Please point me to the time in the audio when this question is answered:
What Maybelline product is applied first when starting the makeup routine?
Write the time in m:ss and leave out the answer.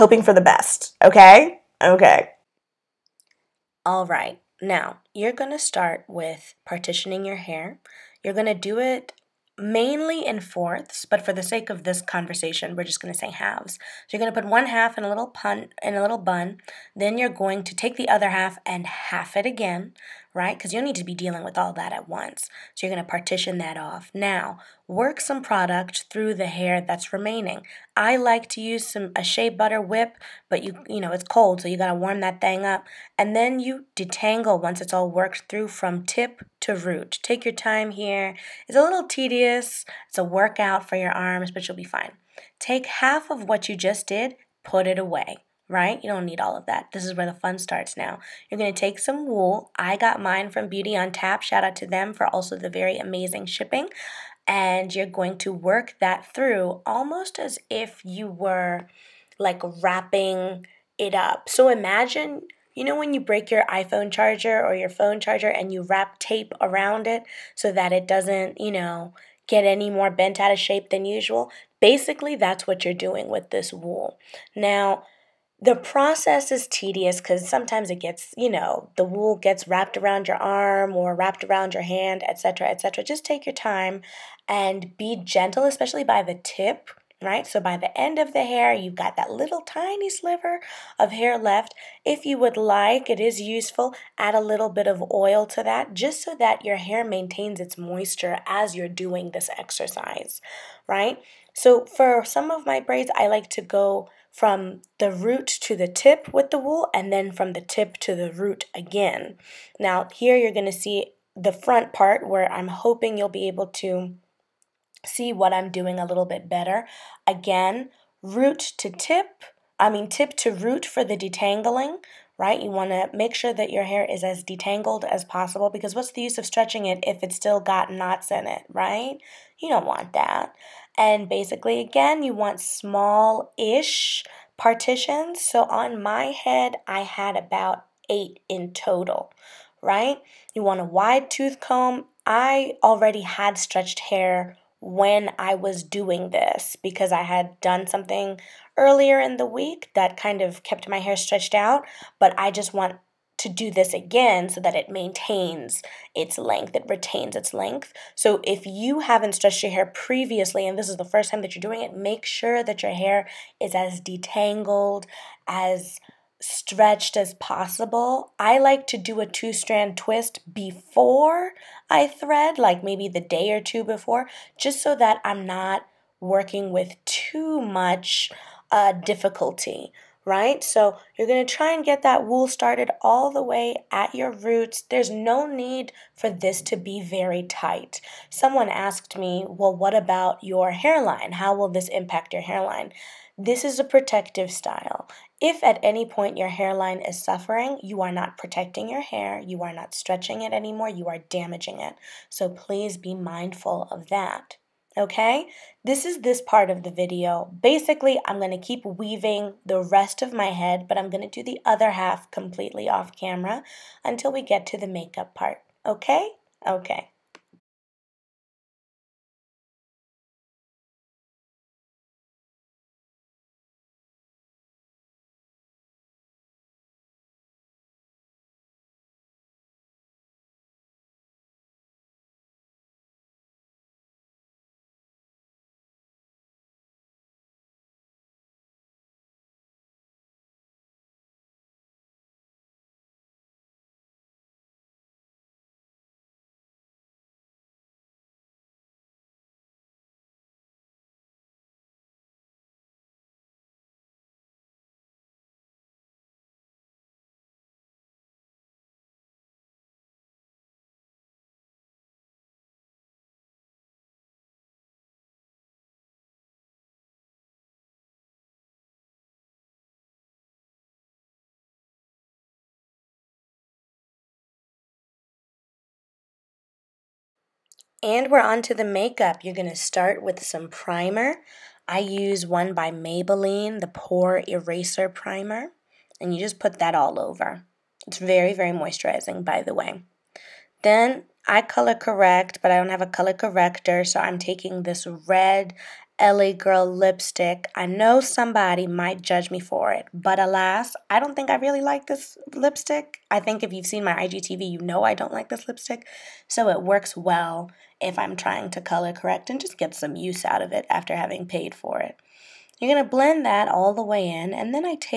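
4:43.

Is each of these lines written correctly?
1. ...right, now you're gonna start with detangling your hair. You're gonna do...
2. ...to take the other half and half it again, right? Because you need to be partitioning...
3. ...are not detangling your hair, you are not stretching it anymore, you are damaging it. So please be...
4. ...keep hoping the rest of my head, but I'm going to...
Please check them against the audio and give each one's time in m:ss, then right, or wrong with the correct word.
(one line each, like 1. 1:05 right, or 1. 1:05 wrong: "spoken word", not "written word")
1. 0:04 wrong: "partitioning", not "detangling"
2. 0:17 wrong: "dealing", not "partitioning"
3. 3:18 wrong: "protecting", not "detangling"
4. 3:28 wrong: "weaving", not "hoping".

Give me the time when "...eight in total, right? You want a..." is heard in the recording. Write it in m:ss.
2:18.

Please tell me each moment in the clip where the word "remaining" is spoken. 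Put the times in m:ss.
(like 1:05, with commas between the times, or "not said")
0:27.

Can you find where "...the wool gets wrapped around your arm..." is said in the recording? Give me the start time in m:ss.
1:18.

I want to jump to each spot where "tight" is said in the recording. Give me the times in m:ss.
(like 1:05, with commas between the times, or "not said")
3:07.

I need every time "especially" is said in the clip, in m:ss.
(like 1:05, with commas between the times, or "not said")
1:25.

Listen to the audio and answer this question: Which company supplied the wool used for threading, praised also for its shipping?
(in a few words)
Beauty on Tap.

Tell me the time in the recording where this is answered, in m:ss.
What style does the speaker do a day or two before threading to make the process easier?
2:49.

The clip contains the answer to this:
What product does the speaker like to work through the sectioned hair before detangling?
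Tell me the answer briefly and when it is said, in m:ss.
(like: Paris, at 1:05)
Shea butter whip, at 0:29.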